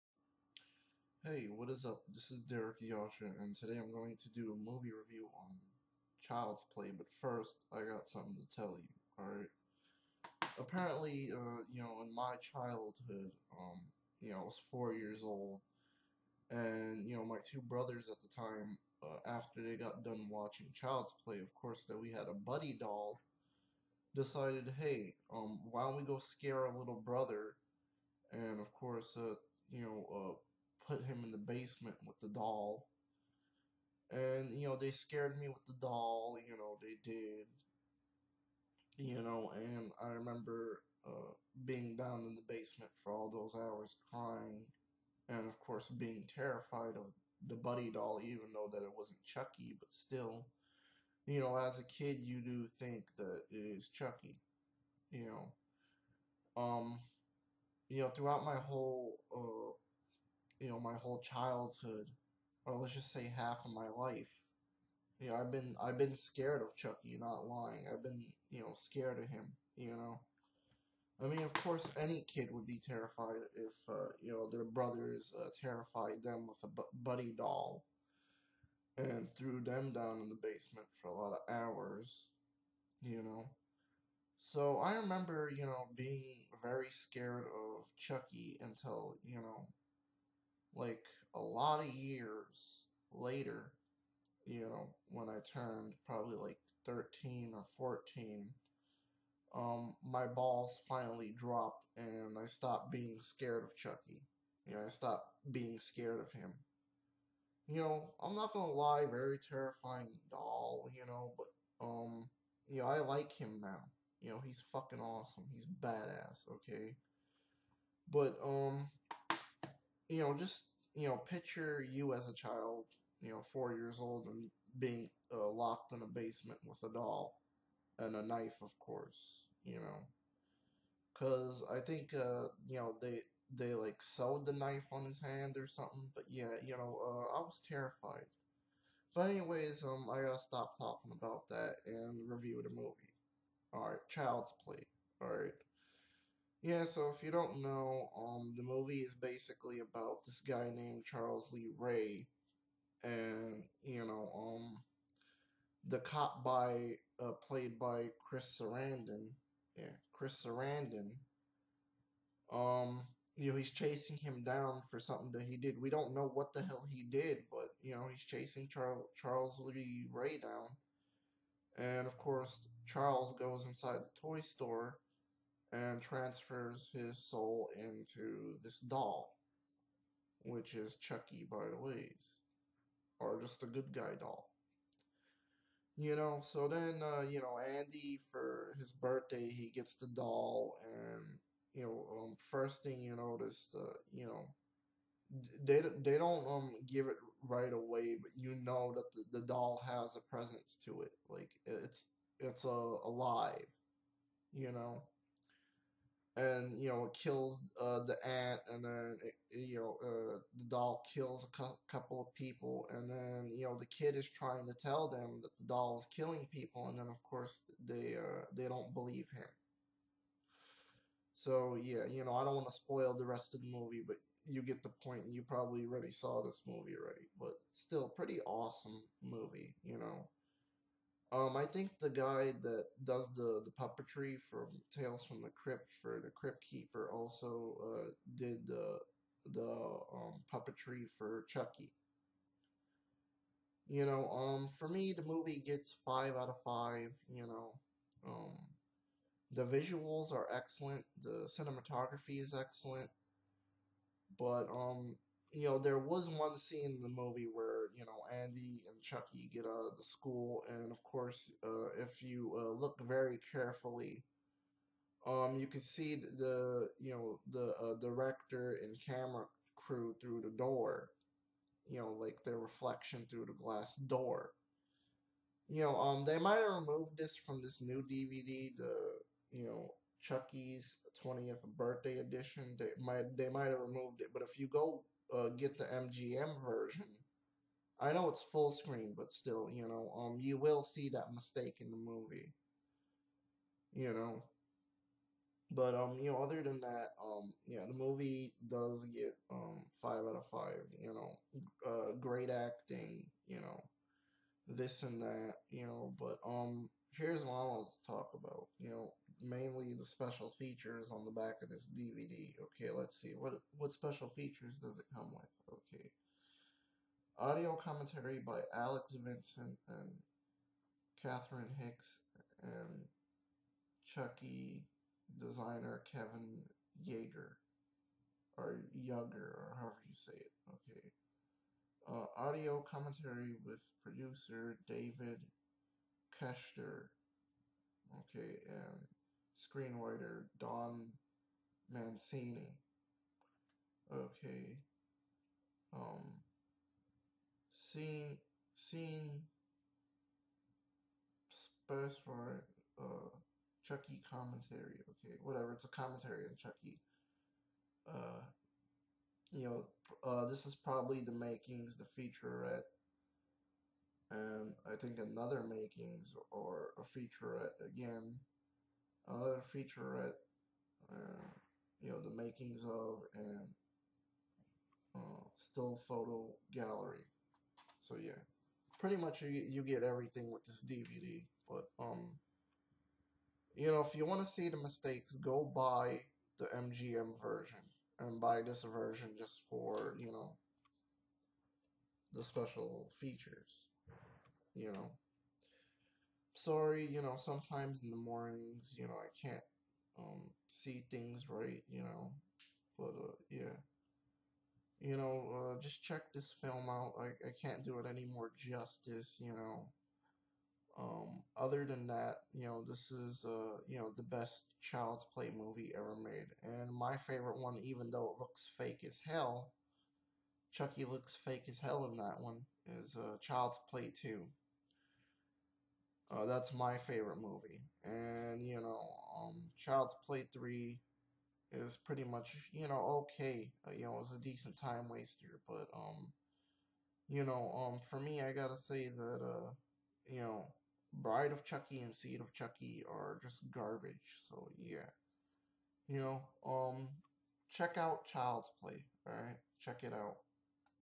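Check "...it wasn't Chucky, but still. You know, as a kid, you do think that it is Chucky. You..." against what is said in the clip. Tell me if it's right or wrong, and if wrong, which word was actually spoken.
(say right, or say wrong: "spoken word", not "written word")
right.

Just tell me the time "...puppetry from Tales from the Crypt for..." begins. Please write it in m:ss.
3:53.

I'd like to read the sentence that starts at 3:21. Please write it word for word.
Like, it's, it's uh, alive, you know?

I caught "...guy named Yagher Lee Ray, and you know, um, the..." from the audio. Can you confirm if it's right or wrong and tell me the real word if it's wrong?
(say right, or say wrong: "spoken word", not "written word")
wrong: "Charles", not "Yagher".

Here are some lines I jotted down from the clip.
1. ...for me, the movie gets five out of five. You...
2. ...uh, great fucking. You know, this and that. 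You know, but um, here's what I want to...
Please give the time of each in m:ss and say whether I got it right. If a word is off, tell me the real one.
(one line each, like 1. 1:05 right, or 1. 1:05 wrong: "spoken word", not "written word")
1. 4:04 right
2. 5:01 wrong: "acting", not "fucking".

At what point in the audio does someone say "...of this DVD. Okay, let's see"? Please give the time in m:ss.
5:11.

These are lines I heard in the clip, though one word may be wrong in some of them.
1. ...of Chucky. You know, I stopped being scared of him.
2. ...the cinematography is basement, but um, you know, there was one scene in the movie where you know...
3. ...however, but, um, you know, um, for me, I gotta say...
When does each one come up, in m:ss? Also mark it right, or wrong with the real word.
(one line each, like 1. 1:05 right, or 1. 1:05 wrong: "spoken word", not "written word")
1. 1:43 right
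2. 4:11 wrong: "excellent", not "basement"
3. 7:15 wrong: "waster", not "however".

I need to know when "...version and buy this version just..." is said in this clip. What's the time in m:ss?
6:27.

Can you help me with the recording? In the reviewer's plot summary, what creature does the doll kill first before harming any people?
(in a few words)
The ant.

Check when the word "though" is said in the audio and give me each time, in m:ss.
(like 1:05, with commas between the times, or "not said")
0:48, 6:58.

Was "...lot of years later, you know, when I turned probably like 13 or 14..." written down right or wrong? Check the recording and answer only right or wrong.
right.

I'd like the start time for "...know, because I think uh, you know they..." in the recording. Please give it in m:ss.
2:09.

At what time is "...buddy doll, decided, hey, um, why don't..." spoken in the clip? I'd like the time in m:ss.
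0:22.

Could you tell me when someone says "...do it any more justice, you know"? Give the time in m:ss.
6:47.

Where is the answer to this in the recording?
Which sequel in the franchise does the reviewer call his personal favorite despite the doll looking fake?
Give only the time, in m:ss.
7:03.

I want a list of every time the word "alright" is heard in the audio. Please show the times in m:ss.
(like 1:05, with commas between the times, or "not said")
0:09, 7:29.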